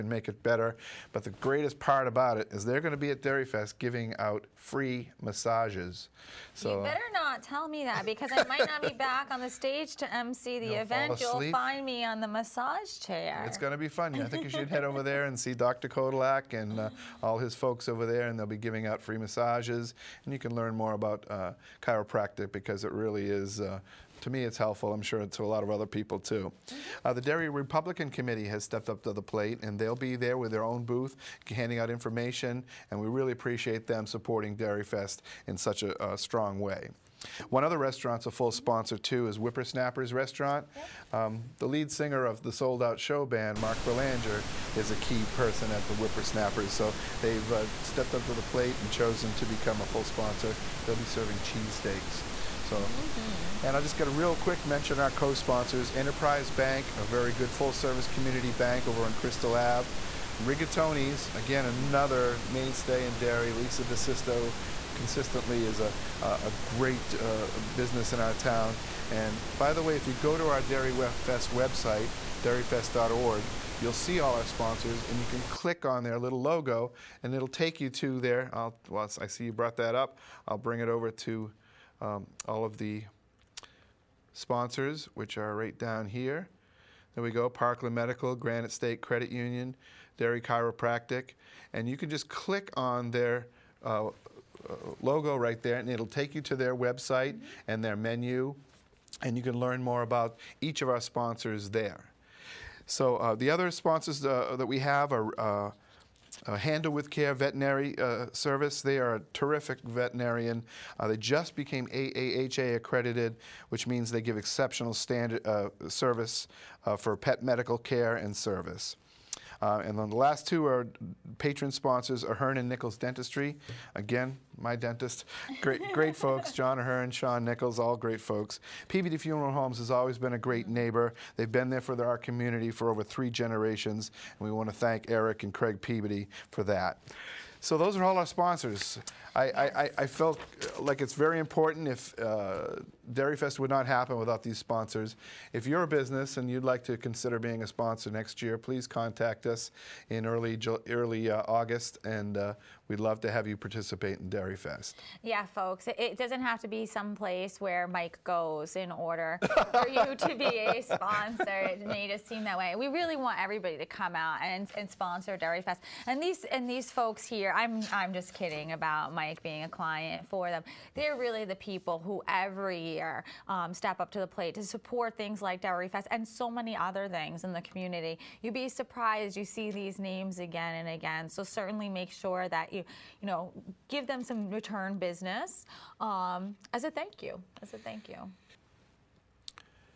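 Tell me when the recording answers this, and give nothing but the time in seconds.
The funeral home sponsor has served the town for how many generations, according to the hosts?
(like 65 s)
133 s.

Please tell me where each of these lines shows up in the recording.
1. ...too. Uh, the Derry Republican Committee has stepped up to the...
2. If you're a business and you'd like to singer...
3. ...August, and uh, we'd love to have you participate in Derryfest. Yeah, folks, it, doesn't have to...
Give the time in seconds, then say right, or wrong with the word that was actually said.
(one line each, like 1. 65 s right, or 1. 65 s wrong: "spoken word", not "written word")
1. 26 s right
2. 145 s wrong: "consider", not "singer"
3. 151 s right.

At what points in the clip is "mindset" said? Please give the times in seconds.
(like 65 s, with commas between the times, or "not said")
not said.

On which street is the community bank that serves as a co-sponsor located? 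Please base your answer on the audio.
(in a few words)
Crystal Ave.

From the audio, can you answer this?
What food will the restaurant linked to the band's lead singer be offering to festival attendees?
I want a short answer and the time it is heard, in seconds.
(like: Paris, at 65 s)
Cheesesteaks, at 51 s.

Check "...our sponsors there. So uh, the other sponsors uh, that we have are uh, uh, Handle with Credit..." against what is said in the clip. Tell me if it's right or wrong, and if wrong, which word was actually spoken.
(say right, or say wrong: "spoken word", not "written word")
wrong: "Care", not "Credit".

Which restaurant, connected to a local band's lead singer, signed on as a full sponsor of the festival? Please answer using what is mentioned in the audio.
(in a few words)
Whippersnappers Restaurant.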